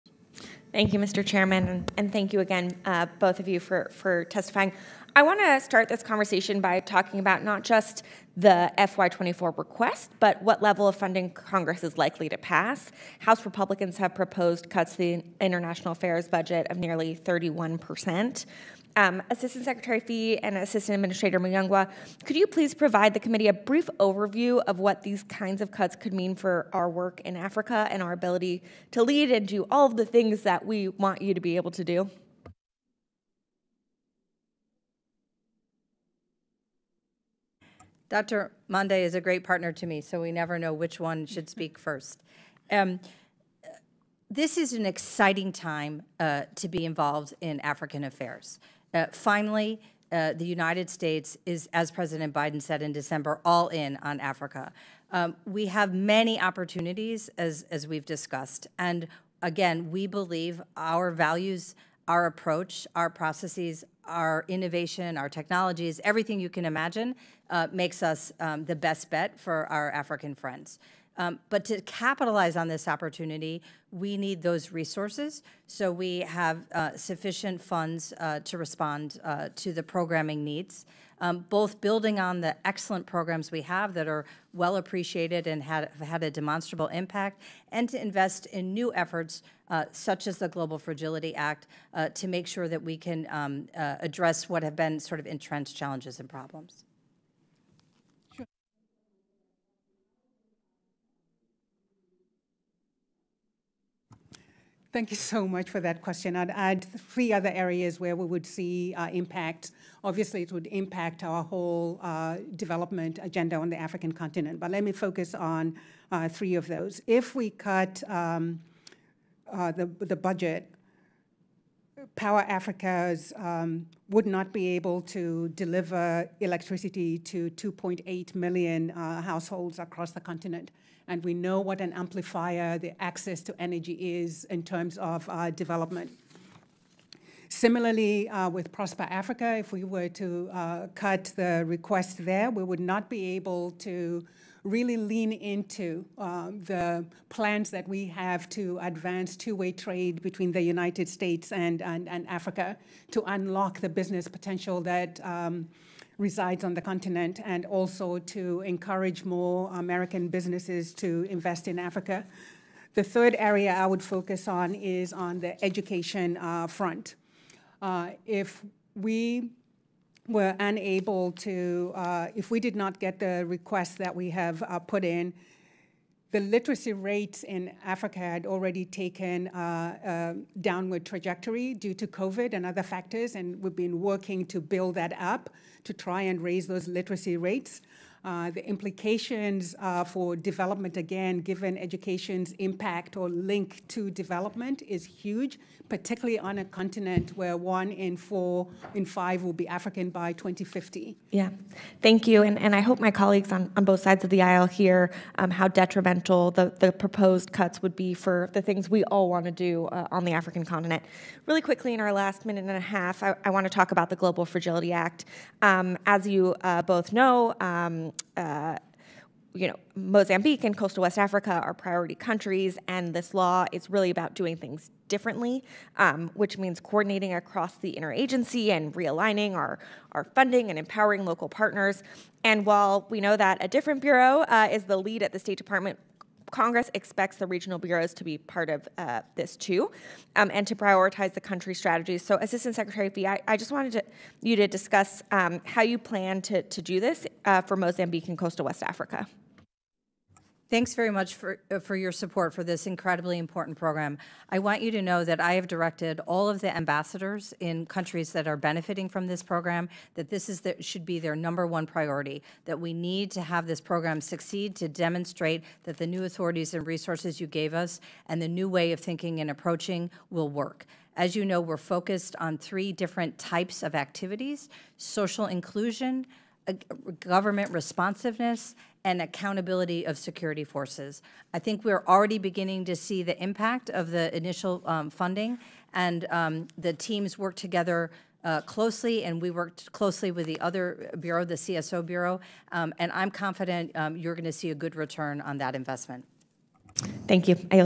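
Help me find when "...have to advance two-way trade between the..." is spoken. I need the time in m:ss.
2:28.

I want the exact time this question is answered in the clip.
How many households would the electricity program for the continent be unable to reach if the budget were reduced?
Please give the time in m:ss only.
2:07.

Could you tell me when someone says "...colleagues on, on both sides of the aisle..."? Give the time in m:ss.
3:23.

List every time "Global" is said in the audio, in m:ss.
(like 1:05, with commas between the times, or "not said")
1:30, 3:34.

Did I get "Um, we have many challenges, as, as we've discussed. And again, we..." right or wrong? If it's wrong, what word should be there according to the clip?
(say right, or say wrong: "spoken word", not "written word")
wrong: "opportunities", not "challenges".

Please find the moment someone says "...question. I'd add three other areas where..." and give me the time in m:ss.
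1:46.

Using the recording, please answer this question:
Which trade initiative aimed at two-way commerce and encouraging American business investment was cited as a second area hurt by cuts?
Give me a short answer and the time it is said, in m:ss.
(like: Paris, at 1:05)
Prosper Africa, at 2:18.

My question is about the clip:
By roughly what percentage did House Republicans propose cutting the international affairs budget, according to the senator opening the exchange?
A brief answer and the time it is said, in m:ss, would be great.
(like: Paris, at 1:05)
31 percent, at 0:17.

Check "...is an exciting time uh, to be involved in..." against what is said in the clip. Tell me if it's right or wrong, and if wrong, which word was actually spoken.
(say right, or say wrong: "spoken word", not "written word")
right.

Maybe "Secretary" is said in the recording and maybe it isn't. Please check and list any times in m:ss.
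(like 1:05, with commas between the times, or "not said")
0:19, 4:02.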